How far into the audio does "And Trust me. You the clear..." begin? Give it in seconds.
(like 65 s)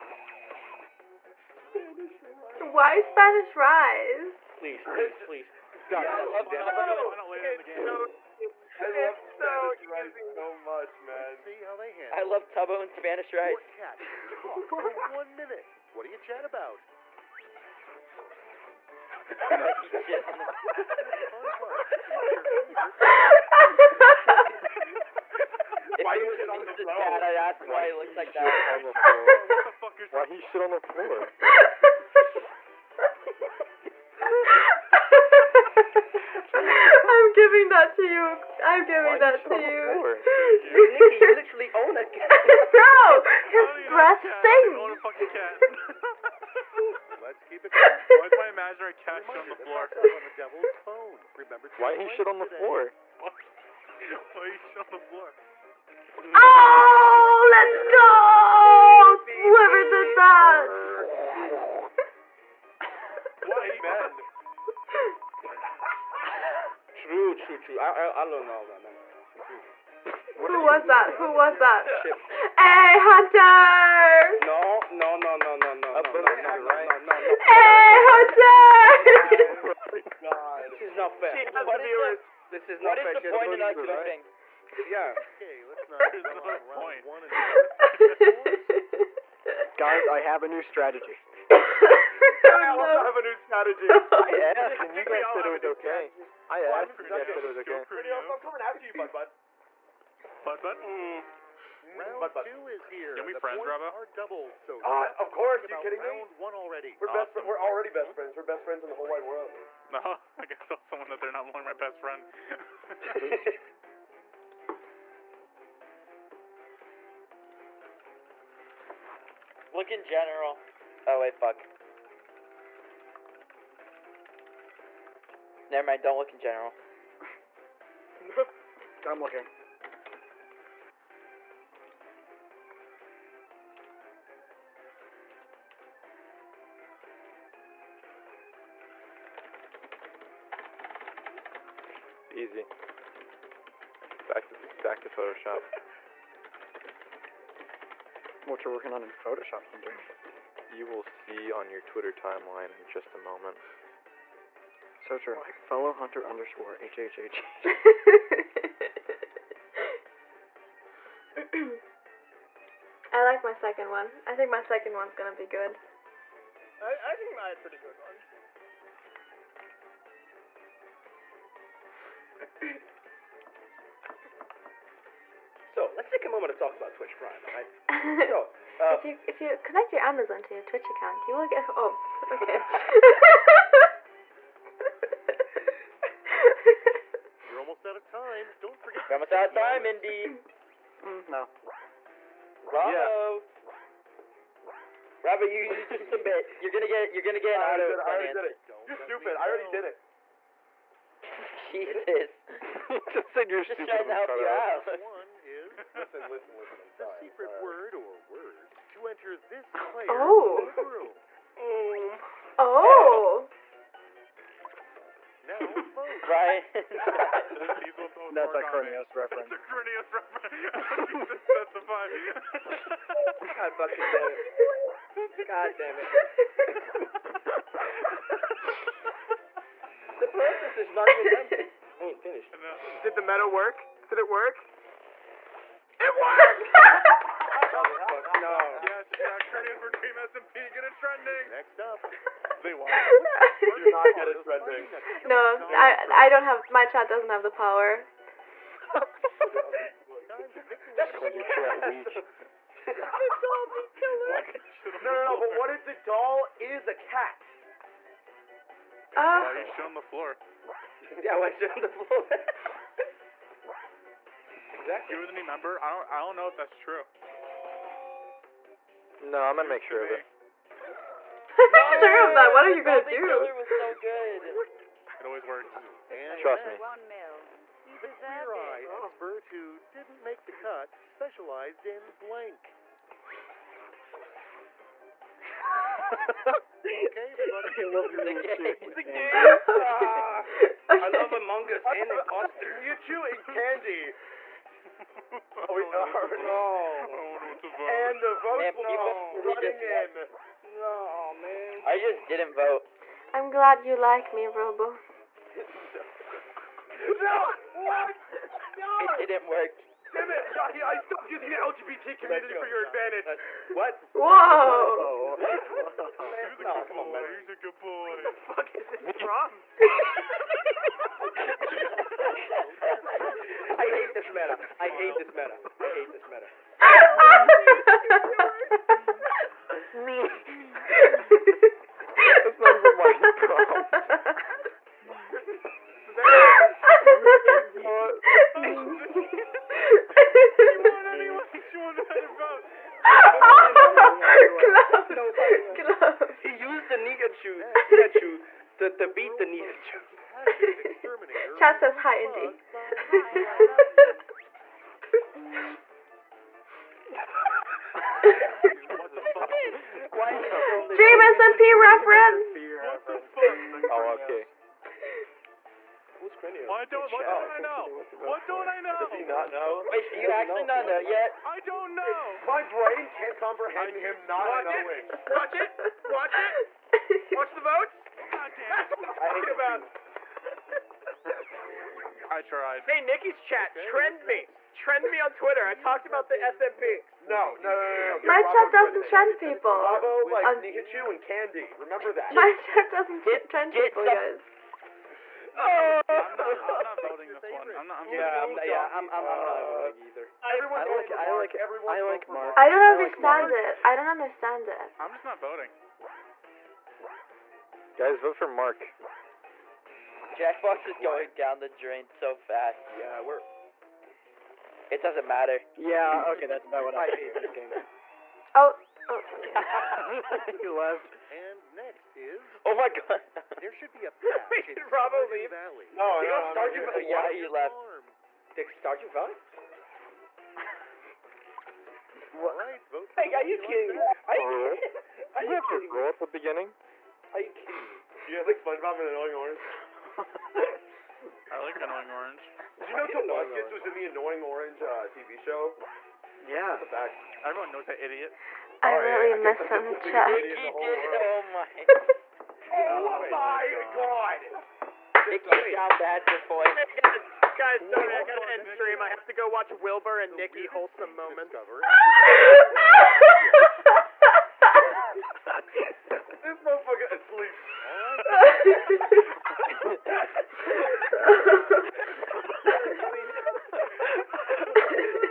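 276 s.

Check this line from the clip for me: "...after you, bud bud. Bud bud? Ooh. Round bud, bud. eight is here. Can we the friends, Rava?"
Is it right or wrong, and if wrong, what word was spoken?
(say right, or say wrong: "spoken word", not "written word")
wrong: "two", not "eight".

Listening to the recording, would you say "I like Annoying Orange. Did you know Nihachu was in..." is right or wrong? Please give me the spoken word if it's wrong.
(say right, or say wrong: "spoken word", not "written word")
wrong: "Tobuscus", not "Nihachu".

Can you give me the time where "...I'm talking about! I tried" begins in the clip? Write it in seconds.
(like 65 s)
379 s.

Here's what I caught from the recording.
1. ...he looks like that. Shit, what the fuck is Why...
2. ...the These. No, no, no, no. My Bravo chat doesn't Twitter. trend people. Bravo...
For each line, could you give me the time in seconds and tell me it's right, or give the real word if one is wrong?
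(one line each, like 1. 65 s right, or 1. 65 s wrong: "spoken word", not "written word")
1. 27 s right
2. 386 s wrong: "SMP", not "These".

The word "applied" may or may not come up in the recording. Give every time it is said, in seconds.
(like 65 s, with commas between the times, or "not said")
not said.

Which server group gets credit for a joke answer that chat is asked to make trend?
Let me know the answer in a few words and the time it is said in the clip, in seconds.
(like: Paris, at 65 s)
Team SMP, at 239 s.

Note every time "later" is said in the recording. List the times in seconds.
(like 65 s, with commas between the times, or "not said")
7 s.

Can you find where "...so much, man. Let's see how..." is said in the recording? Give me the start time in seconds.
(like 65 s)
10 s.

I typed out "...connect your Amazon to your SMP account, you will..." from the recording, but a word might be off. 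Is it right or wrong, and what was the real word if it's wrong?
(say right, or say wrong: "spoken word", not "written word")
wrong: "Twitch", not "SMP".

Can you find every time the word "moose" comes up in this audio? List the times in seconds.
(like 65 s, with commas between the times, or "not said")
not said.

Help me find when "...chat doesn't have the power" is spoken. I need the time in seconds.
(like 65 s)
246 s.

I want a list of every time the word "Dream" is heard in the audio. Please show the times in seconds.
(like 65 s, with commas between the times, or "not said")
360 s.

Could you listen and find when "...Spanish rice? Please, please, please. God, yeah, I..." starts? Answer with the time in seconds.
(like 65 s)
3 s.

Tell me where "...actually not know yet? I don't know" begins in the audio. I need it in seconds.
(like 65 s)
370 s.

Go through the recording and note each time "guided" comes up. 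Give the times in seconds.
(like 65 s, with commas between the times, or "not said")
not said.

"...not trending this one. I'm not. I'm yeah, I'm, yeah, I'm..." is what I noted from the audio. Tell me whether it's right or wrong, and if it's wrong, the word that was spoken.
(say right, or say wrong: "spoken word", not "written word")
wrong: "voting", not "trending".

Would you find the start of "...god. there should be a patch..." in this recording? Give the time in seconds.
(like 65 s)
422 s.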